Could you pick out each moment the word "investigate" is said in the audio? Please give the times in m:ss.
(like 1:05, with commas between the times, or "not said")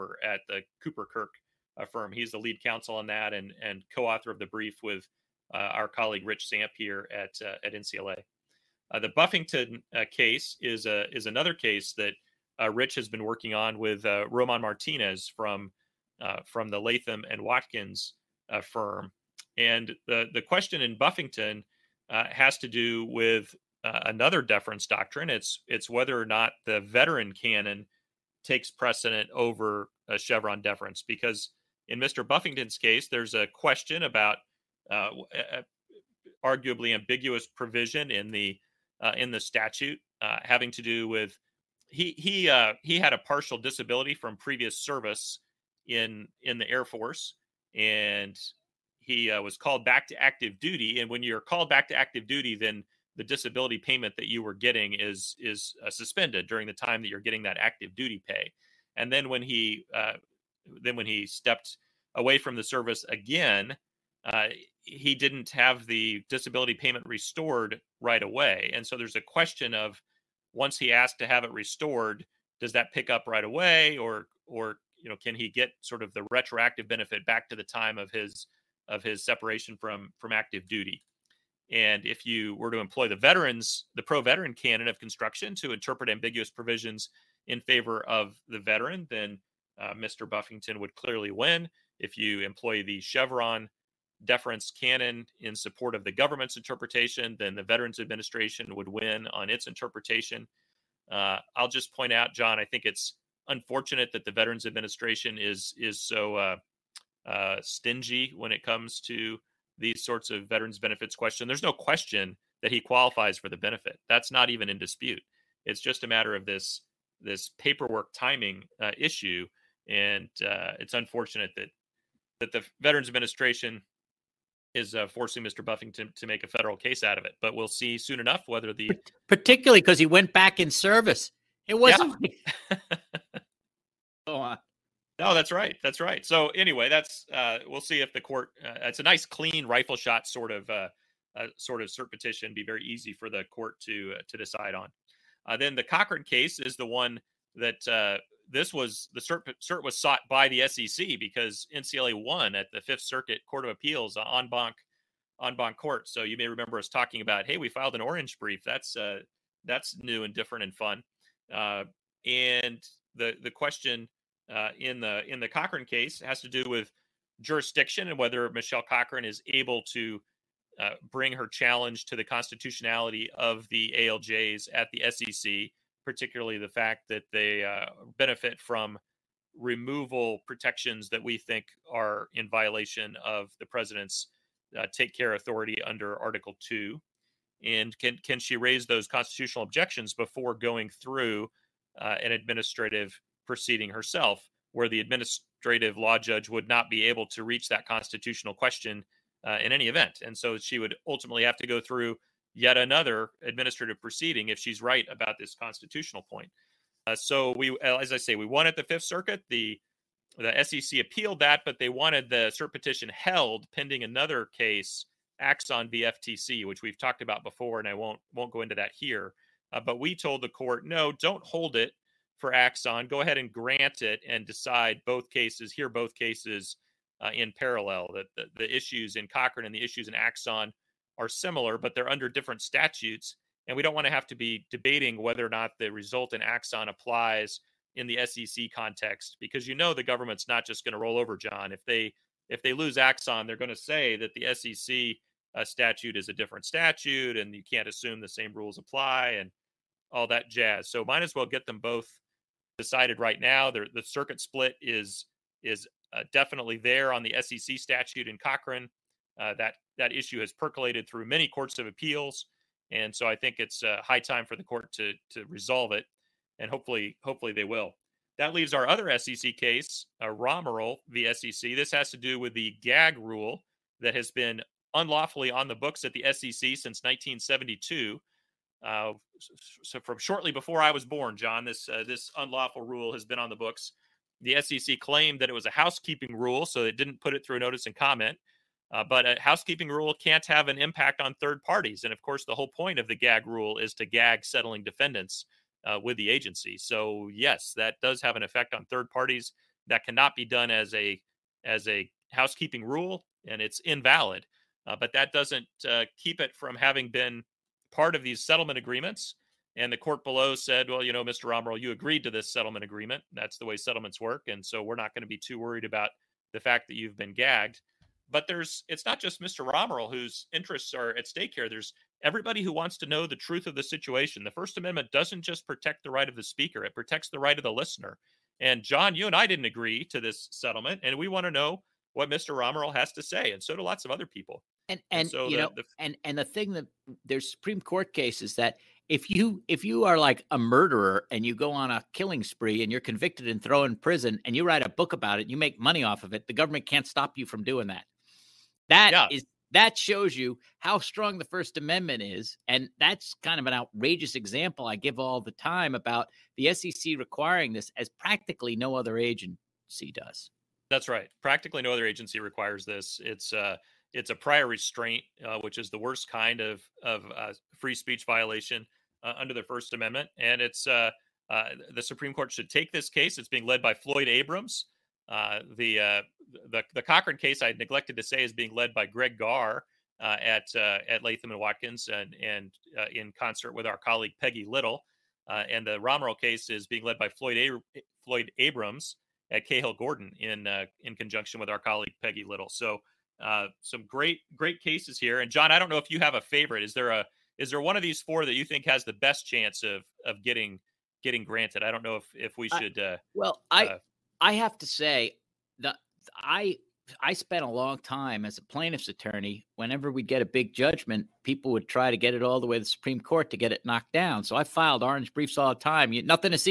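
not said.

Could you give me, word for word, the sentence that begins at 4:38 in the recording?
Uh, so from shortly before I was born, John, this uh, this unlawful rule has been on the books.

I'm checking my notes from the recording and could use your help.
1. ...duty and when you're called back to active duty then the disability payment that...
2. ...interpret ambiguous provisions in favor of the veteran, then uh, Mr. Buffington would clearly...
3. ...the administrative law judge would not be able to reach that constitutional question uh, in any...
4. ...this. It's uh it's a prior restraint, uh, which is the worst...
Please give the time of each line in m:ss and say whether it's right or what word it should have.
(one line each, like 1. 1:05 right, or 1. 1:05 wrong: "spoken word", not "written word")
1. 0:50 right
2. 1:25 right
3. 3:14 right
4. 6:02 right.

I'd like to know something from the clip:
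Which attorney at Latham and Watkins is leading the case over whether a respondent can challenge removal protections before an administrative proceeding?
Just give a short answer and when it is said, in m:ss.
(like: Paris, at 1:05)
Greg Garre, at 6:19.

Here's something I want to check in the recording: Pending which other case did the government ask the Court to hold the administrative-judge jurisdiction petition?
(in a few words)
Axon v. FTC.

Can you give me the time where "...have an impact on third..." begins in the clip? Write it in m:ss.
4:50.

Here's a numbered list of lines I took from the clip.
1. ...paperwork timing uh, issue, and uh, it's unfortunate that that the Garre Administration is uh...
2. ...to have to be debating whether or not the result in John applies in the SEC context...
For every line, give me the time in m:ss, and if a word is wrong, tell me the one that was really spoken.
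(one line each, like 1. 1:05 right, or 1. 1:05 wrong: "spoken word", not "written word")
1. 1:57 wrong: "Veterans", not "Garre"
2. 3:54 wrong: "Axon", not "John".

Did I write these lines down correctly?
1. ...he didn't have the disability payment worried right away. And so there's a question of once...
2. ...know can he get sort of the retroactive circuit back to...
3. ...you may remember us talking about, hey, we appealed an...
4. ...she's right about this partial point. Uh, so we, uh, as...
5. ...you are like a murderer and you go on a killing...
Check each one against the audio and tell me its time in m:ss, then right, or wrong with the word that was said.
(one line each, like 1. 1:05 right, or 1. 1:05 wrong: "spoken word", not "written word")
1. 1:04 wrong: "restored", not "worried"
2. 1:15 wrong: "benefit", not "circuit"
3. 2:36 wrong: "filed", not "appealed"
4. 3:24 wrong: "constitutional", not "partial"
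5. 5:39 right.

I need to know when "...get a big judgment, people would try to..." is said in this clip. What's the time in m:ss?
6:50.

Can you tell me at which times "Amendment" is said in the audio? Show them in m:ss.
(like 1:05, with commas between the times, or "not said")
5:24, 5:51, 6:09.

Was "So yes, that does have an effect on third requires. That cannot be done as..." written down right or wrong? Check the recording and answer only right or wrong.
wrong.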